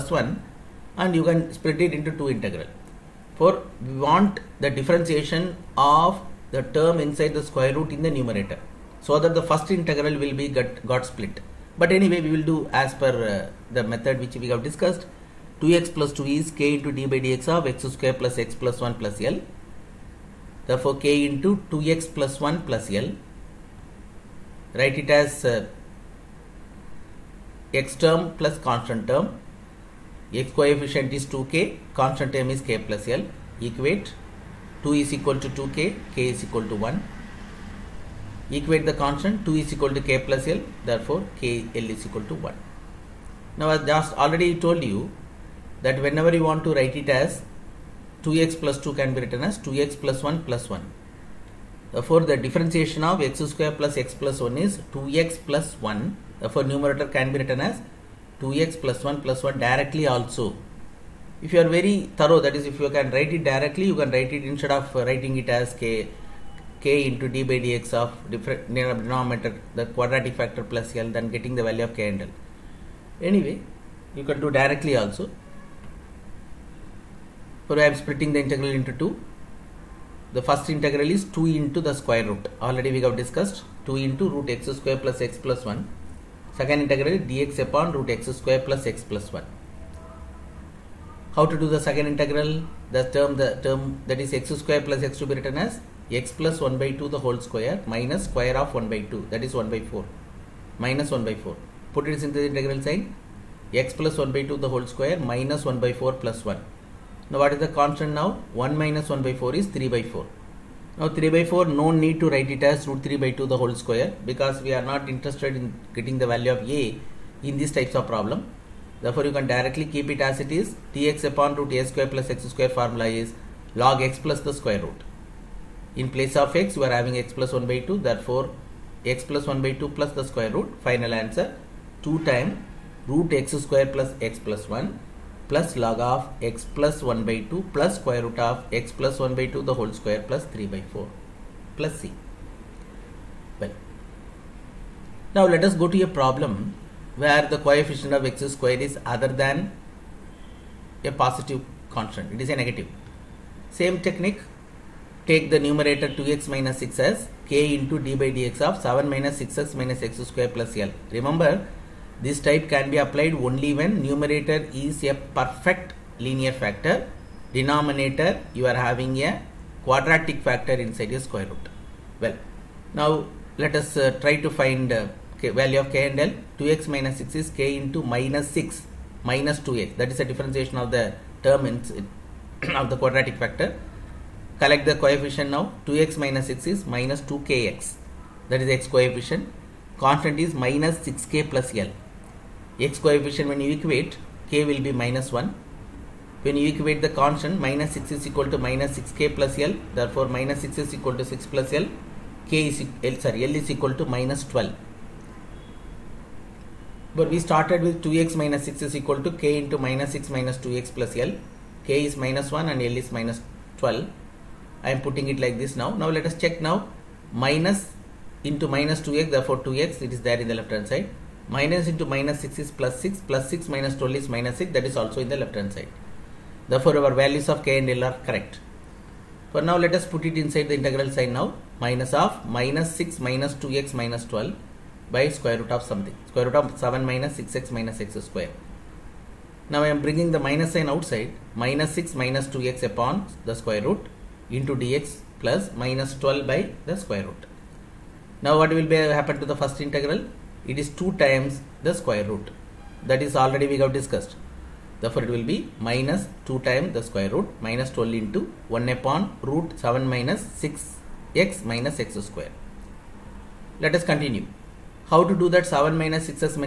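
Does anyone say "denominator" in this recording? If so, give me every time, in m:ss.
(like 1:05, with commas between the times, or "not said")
1:09, 2:47.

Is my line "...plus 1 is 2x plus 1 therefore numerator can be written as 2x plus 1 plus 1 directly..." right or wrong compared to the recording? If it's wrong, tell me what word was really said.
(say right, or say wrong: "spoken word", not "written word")
right.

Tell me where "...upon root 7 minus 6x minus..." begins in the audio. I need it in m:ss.
4:18.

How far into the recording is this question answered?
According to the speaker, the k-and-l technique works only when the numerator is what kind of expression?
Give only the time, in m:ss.
2:45.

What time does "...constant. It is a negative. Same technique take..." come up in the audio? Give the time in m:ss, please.
2:31.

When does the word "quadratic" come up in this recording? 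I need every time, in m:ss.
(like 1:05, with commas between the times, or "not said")
1:09, 2:49, 3:02.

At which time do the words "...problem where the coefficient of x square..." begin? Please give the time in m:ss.
2:26.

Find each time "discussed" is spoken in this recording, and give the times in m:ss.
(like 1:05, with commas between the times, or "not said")
0:14, 1:23, 4:13.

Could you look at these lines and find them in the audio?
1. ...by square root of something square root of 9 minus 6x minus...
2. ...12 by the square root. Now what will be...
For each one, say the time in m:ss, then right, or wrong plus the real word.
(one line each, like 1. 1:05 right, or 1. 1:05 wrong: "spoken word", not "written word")
1. 3:55 wrong: "7", not "9"
2. 4:06 right.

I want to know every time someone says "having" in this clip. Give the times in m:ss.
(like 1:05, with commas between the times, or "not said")
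2:06, 2:48.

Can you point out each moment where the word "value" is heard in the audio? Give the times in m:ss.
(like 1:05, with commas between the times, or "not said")
1:11, 1:56, 2:55, 3:47.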